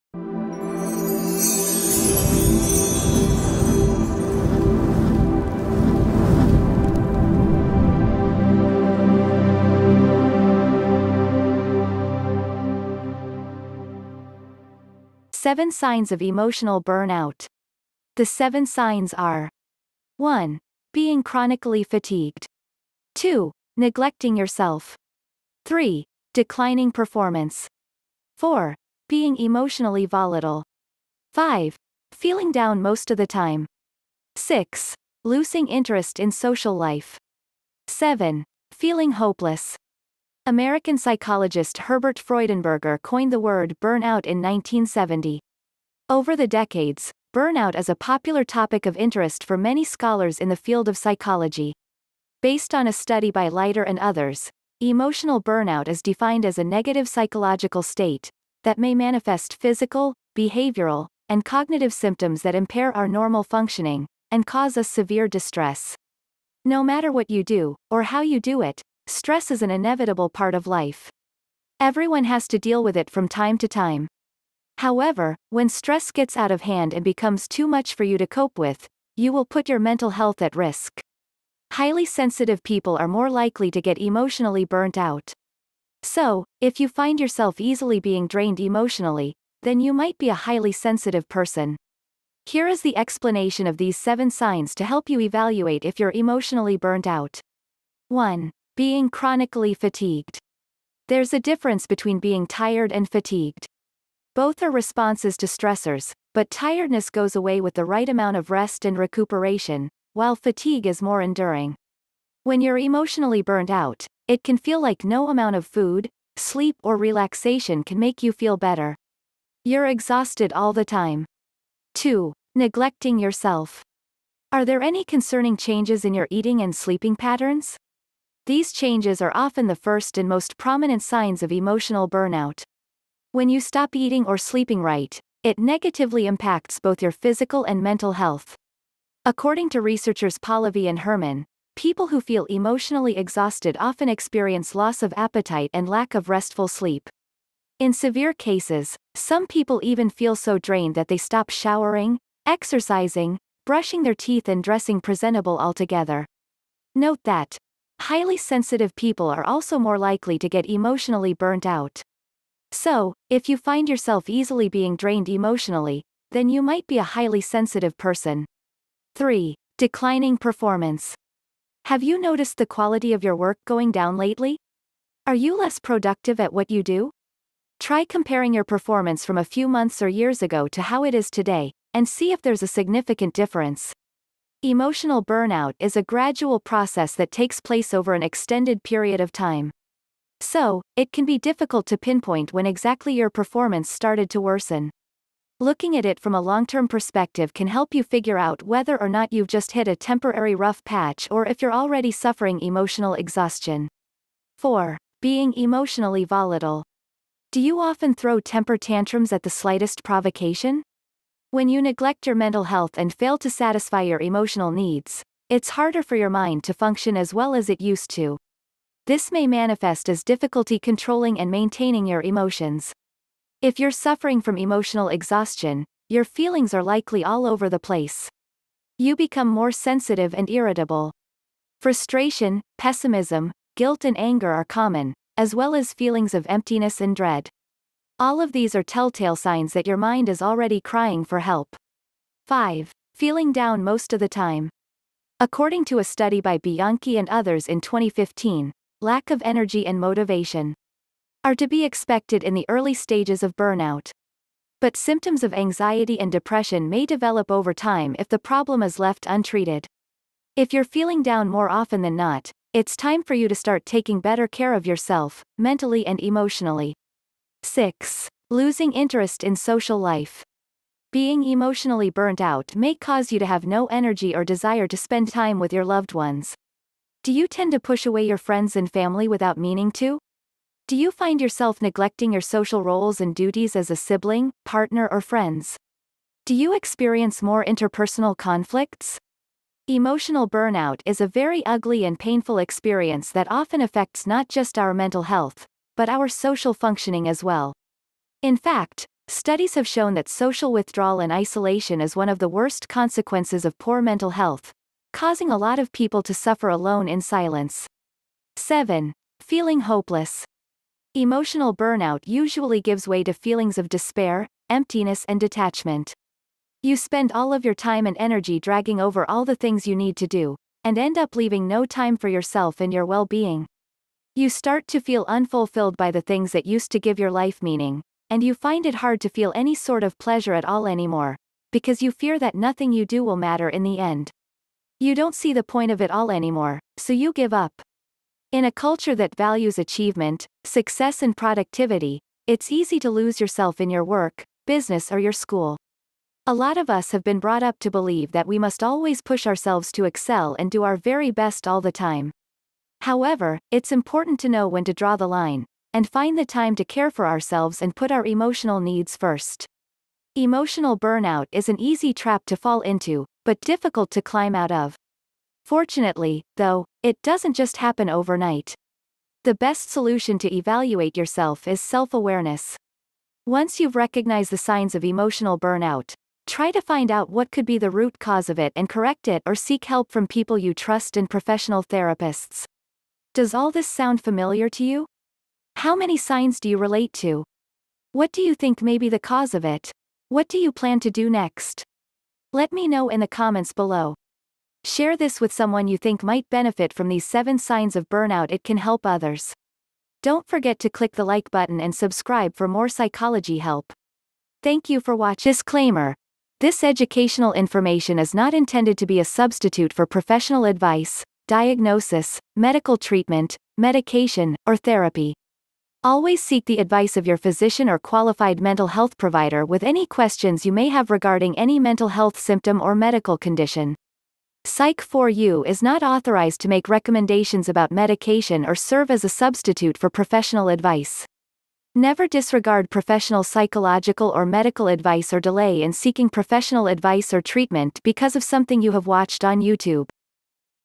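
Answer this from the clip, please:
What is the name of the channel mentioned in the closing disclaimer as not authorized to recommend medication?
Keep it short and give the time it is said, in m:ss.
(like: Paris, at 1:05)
Psych4U, at 7:04.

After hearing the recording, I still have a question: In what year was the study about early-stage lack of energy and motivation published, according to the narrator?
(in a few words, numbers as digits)
2015.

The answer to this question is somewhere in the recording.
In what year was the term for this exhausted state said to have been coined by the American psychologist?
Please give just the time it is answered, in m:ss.
0:44.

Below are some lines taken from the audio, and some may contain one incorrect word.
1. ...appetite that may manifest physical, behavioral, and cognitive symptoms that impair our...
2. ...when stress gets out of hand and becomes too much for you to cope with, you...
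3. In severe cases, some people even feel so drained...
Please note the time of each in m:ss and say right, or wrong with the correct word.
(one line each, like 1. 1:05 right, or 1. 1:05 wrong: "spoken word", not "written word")
1. 0:57 wrong: "state", not "appetite"
2. 1:15 right
3. 2:27 right.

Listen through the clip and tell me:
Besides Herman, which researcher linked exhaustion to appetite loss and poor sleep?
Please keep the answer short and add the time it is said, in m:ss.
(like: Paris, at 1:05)
Pallavi, at 2:20.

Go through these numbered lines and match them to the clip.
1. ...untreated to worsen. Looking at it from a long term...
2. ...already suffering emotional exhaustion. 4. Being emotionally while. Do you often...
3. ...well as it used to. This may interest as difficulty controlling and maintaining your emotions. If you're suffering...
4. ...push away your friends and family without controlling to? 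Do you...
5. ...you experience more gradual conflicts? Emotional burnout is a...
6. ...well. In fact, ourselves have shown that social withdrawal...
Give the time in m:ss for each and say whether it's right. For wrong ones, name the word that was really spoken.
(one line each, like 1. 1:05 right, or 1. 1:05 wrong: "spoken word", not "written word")
1. 3:13 wrong: "started", not "untreated"
2. 3:21 wrong: "volatile", not "while"
3. 3:37 wrong: "manifest", not "interest"
4. 4:37 wrong: "meaning", not "controlling"
5. 4:46 wrong: "interpersonal", not "gradual"
6. 4:57 wrong: "studies", not "ourselves".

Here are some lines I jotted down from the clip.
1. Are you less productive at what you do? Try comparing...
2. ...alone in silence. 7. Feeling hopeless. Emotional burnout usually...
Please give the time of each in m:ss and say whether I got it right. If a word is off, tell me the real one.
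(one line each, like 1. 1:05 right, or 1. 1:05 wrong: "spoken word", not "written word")
1. 2:55 right
2. 5:06 right.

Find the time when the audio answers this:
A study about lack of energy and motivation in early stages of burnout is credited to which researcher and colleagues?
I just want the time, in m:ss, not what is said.
4:06.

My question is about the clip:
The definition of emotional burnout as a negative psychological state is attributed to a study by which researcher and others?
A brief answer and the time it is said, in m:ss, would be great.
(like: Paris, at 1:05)
Leiter, at 0:53.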